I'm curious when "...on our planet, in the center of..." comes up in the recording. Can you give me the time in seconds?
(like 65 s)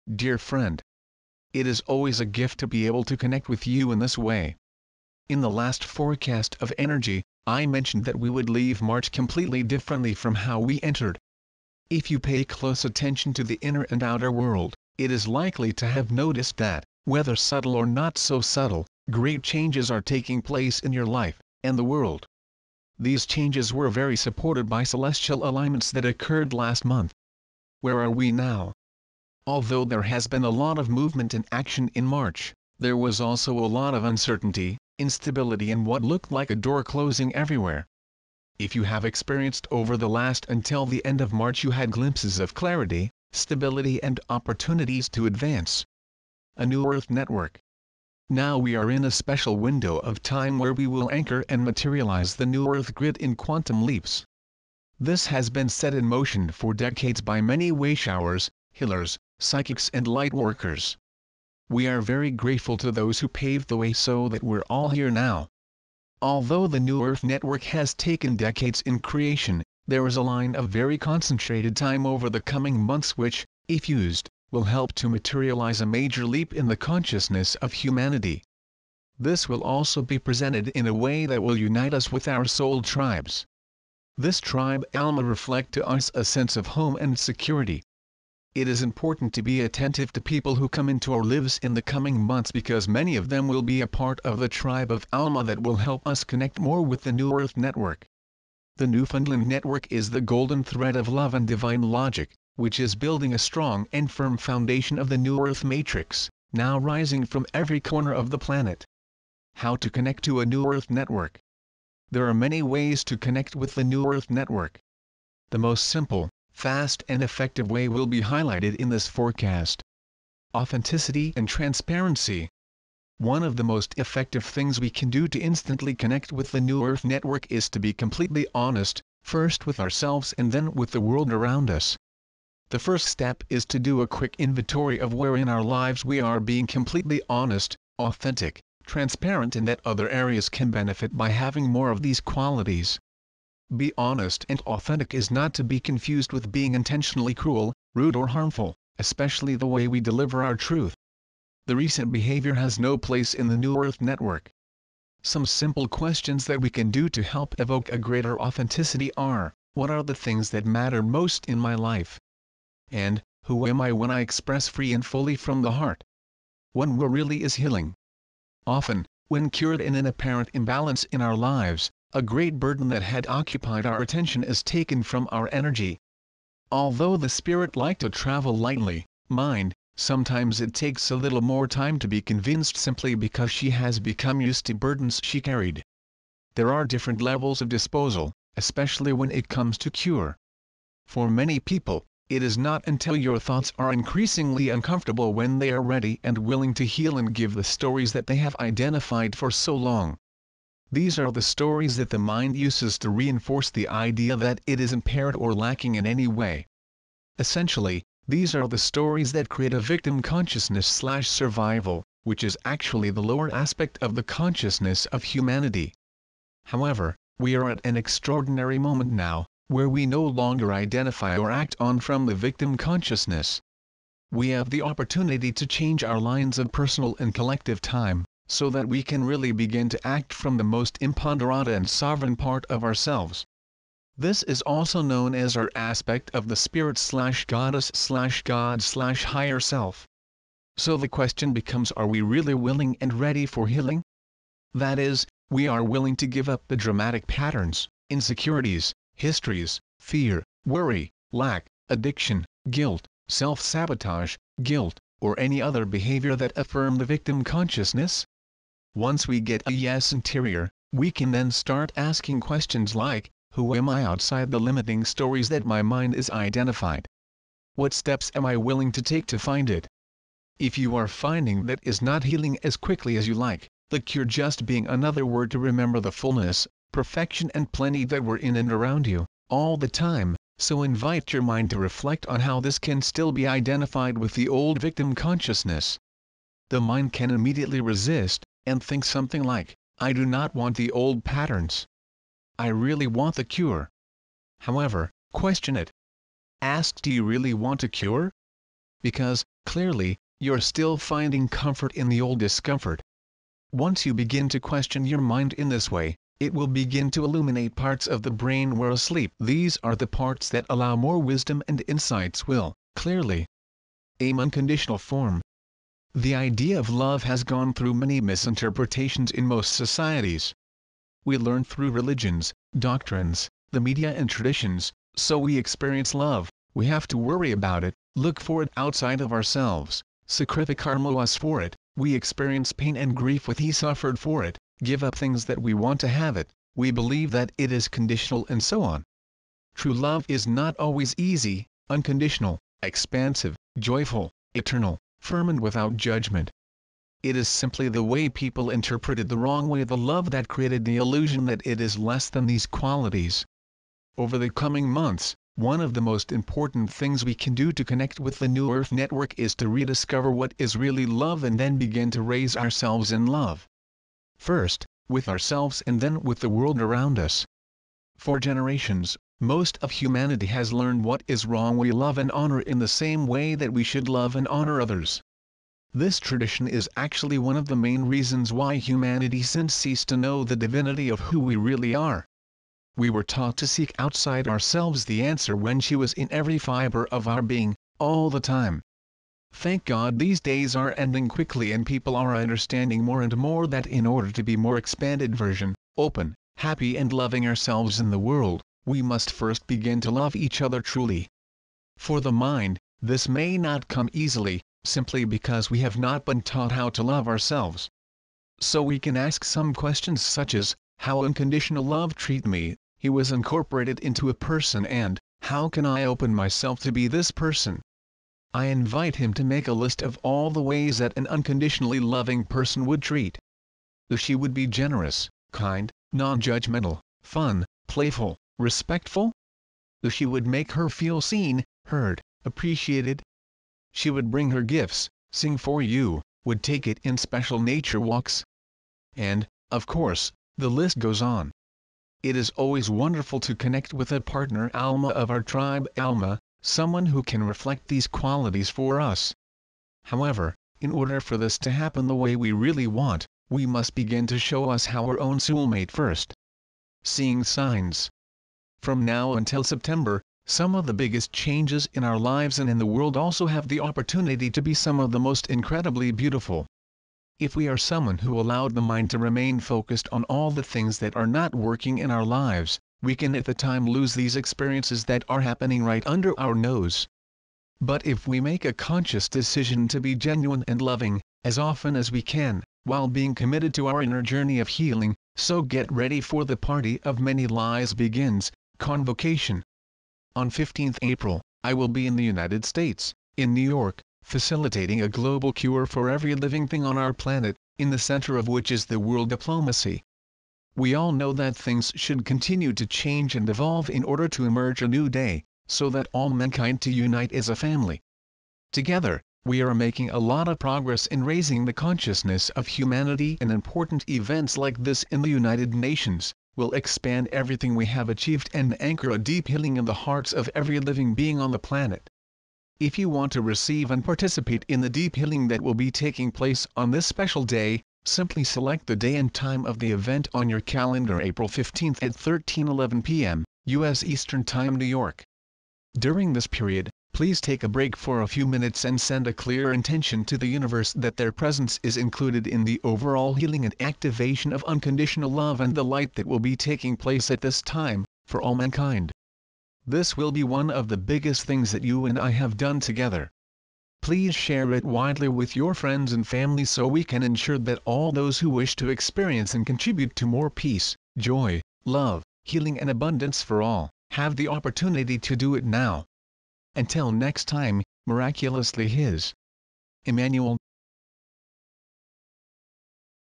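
496 s.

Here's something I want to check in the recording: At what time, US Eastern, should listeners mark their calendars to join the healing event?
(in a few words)
13:11.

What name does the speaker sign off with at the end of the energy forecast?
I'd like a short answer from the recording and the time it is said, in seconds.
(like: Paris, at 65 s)
Emmanuel, at 570 s.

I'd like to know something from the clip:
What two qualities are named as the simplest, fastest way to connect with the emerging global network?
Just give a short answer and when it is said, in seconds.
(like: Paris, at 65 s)
Authenticity and transparency, at 120 s.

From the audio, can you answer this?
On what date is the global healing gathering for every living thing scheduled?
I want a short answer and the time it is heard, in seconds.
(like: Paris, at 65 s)
April 15, at 490 s.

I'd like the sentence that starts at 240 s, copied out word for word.
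So the question becomes are we really willing and ready for healing?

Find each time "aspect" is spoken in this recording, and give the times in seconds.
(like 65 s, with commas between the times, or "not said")
213 s, 235 s.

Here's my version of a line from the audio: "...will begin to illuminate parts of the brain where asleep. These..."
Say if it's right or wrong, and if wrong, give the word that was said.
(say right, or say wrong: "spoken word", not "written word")
right.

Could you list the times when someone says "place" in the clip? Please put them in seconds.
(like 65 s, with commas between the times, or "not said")
20 s, 152 s, 526 s, 546 s.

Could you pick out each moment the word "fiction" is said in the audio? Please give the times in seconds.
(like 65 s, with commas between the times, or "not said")
not said.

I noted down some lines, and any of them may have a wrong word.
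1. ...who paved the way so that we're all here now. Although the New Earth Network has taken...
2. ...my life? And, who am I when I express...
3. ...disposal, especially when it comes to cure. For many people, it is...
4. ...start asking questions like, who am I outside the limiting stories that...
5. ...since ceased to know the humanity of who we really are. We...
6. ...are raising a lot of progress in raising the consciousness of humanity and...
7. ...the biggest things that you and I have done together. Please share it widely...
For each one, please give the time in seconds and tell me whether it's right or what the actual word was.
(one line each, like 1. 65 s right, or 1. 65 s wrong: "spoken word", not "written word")
1. 63 s right
2. 161 s right
3. 187 s right
4. 261 s right
5. 379 s wrong: "divinity", not "humanity"
6. 509 s wrong: "making", not "raising"
7. 550 s right.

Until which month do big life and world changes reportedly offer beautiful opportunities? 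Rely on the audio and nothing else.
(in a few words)
September.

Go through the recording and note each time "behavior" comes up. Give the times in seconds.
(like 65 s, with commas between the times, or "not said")
152 s, 255 s.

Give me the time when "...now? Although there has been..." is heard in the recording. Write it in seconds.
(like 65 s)
28 s.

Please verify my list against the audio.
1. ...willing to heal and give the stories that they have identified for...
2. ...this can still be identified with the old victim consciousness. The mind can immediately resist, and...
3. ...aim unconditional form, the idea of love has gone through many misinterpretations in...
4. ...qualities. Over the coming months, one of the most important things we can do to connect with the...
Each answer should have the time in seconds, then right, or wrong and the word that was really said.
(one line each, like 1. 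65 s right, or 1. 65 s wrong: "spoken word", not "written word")
1. 196 s right
2. 282 s right
3. 314 s right
4. 352 s right.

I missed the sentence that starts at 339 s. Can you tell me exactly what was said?
True love is not always easy, unconditional, expansive, joyful, eternal, firm and without judgment.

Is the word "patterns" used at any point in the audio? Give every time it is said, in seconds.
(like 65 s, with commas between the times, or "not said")
247 s, 291 s.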